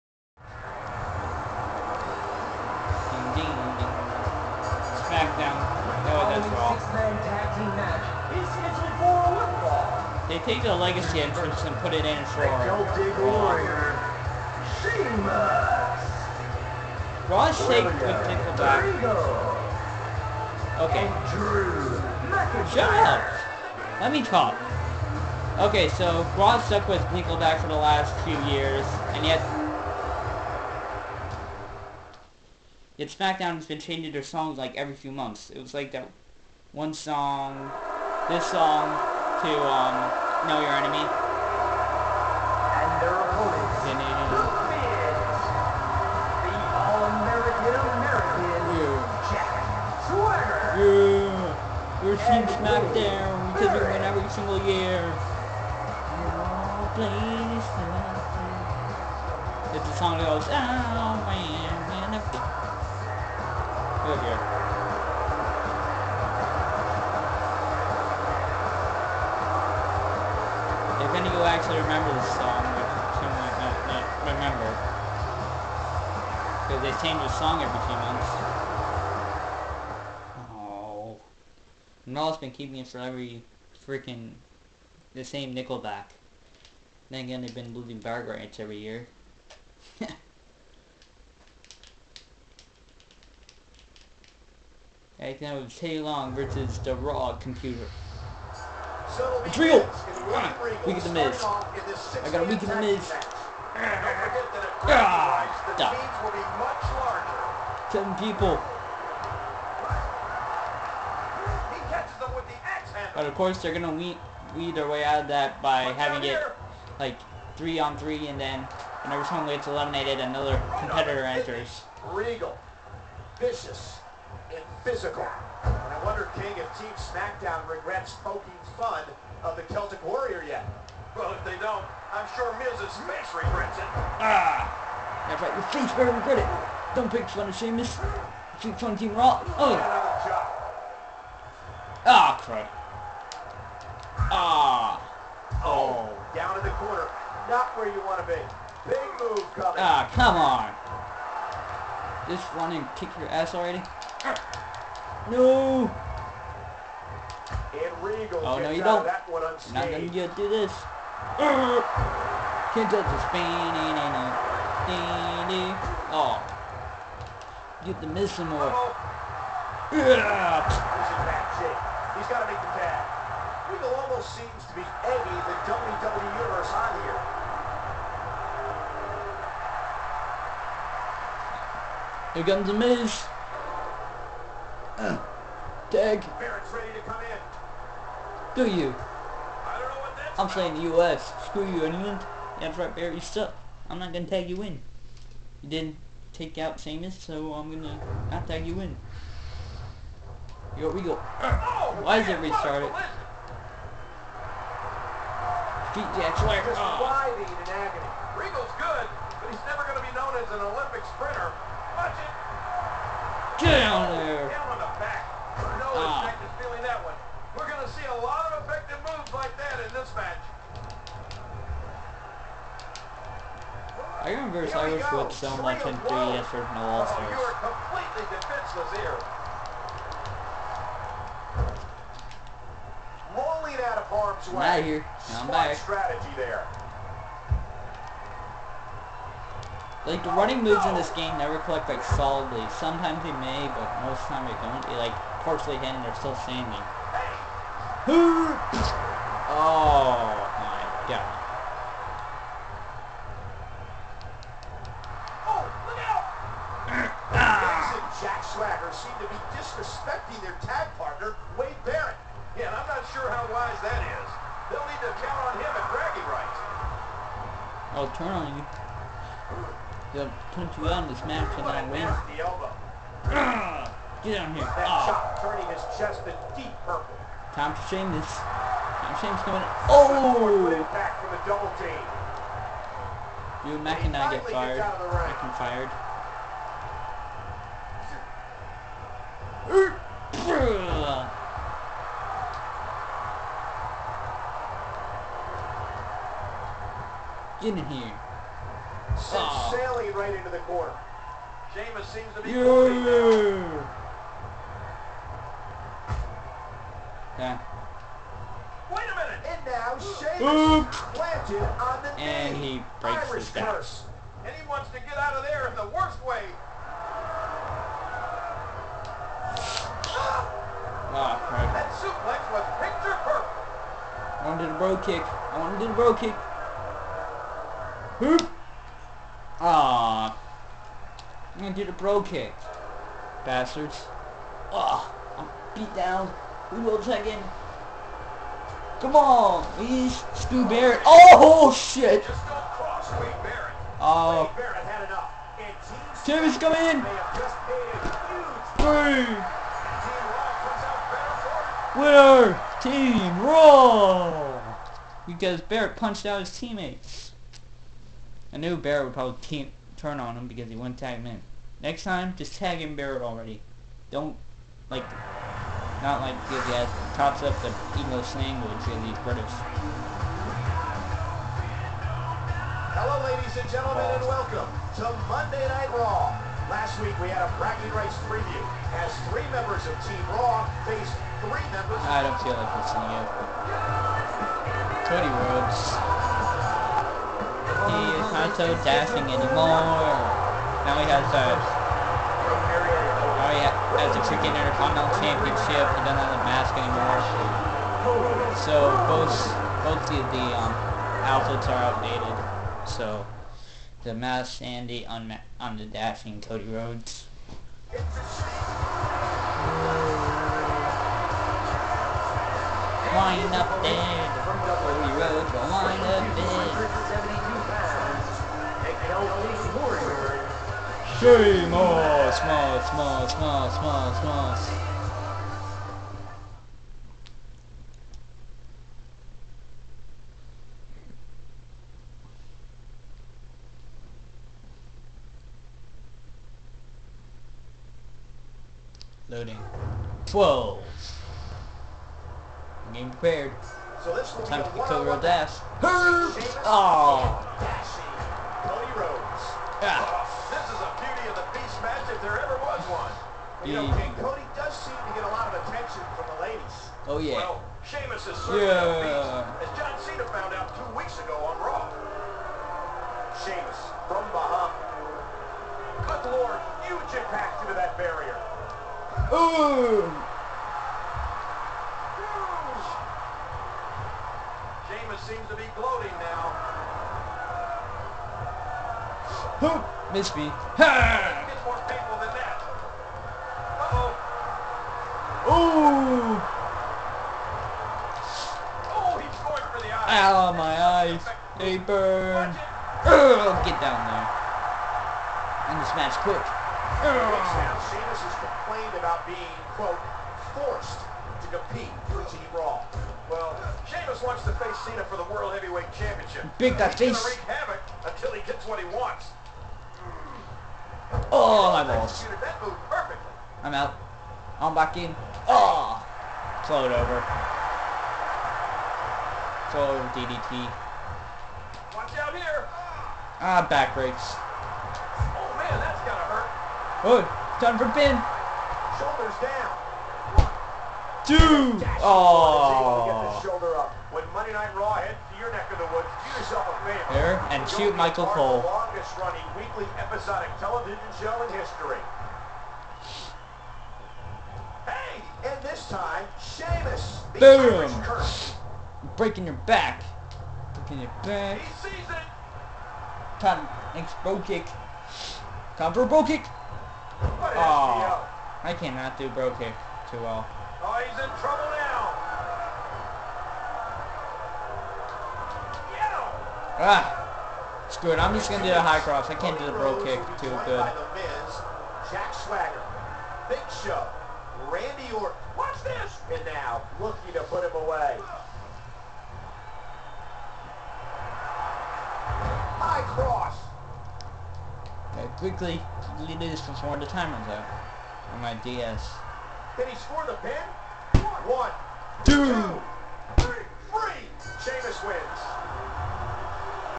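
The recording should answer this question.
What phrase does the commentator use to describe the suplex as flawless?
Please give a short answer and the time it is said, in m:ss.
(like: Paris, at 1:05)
Picture perfect, at 5:22.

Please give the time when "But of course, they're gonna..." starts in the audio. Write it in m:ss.
1:53.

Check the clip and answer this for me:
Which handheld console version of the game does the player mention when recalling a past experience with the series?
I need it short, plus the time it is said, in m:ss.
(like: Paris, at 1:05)
3DS, at 3:46.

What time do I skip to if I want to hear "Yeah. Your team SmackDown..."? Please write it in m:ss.
0:50.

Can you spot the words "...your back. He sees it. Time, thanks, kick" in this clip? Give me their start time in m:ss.
9:11.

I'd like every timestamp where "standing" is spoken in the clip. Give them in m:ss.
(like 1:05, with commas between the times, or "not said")
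4:06.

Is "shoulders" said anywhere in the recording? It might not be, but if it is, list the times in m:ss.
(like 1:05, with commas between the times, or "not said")
8:49, 8:53.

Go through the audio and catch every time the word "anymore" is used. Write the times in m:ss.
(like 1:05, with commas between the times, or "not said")
6:29, 6:36.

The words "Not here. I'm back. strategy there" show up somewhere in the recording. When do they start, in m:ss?
3:54.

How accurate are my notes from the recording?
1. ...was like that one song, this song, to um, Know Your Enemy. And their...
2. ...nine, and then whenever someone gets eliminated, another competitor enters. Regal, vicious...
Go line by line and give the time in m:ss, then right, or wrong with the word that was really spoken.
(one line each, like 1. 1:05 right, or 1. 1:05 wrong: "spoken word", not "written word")
1. 0:35 right
2. 1:57 wrong: "three", not "nine".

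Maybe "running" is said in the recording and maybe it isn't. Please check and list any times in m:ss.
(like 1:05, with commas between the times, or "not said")
4:00, 8:59.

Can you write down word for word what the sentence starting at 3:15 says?
You didn't take out Sheamus, so I'm going to not tag you in.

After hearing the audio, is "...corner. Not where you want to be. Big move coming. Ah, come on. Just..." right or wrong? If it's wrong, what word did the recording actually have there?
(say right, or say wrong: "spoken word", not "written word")
right.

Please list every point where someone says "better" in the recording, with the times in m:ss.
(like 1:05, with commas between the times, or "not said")
2:15.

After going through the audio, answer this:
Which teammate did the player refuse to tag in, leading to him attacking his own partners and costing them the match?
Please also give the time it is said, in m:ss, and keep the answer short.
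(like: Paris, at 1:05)
Wade Barrett, at 4:21.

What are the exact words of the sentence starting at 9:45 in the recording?
quickly do this before the timer's runs out.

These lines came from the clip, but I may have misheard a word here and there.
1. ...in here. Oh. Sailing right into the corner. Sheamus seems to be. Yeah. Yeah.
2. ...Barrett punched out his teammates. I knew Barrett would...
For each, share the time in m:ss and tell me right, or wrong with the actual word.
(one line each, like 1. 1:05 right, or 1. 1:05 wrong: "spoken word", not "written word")
1. 4:57 right
2. 5:55 right.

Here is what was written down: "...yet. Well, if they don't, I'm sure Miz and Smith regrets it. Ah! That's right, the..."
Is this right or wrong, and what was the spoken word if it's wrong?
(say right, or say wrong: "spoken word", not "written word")
right.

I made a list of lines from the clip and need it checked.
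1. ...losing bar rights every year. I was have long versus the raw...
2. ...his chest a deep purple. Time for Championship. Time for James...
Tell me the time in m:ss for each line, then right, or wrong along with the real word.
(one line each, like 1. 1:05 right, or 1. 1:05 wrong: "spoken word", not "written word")
1. 1:27 right
2. 4:35 wrong: "James", not "Championship".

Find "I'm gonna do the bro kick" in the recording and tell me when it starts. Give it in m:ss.
5:31.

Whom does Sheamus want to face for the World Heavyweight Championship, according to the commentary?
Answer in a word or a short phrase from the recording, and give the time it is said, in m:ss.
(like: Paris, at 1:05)
Cena, at 8:24.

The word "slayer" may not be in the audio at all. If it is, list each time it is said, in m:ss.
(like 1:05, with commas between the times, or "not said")
3:26.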